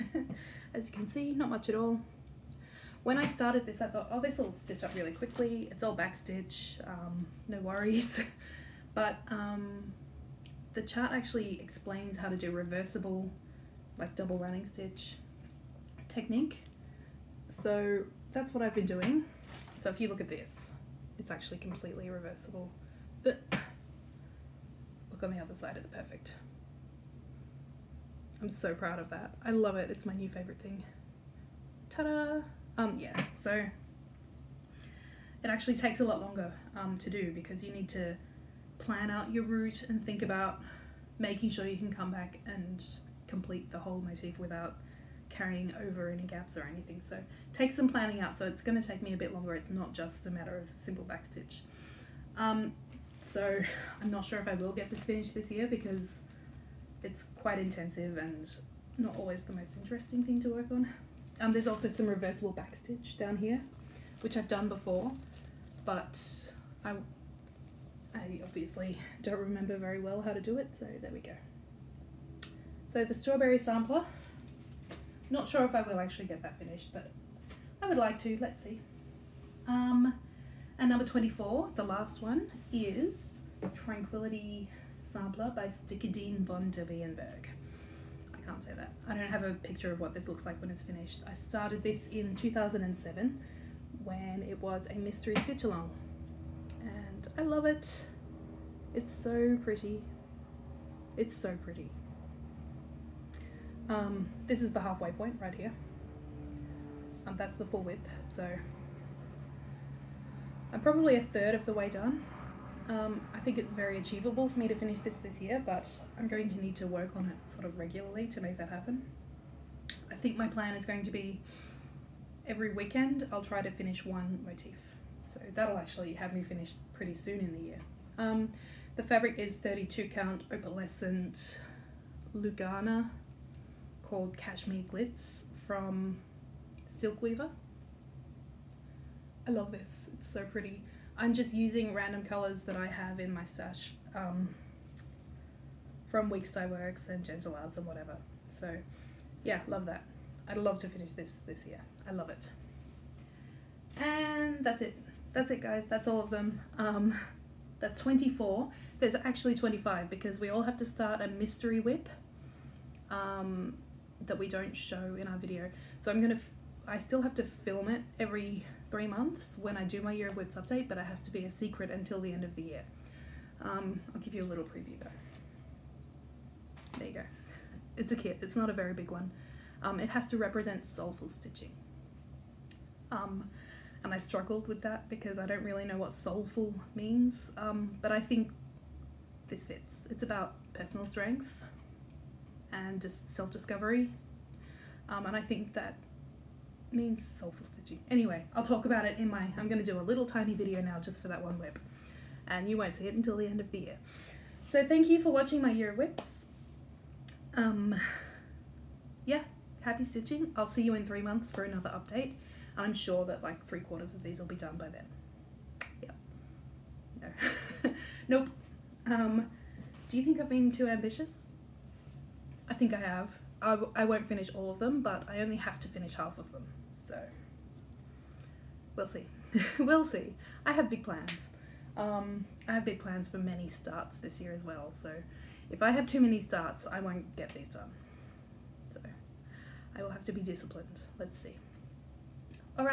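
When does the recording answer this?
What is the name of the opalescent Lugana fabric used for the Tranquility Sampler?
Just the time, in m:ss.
2:14.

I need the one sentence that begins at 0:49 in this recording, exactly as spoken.
It's not just a matter of simple backstitch.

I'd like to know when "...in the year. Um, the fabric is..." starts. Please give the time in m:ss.
2:07.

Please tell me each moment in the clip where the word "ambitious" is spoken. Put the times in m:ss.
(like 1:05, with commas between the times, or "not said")
3:40.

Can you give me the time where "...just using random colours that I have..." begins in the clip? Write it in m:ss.
2:21.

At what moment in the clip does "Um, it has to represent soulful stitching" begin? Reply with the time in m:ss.
2:59.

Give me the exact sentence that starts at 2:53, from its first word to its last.
Um, I'll give you a little preview though.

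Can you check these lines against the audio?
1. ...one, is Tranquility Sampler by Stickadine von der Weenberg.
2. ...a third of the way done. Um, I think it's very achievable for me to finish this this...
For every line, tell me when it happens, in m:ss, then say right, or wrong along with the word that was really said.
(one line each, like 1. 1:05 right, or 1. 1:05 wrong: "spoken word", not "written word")
1. 1:22 right
2. 1:51 right.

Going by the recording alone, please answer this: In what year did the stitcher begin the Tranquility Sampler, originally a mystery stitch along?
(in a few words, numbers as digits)
2007.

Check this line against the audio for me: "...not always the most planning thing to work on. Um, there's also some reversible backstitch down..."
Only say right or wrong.
wrong.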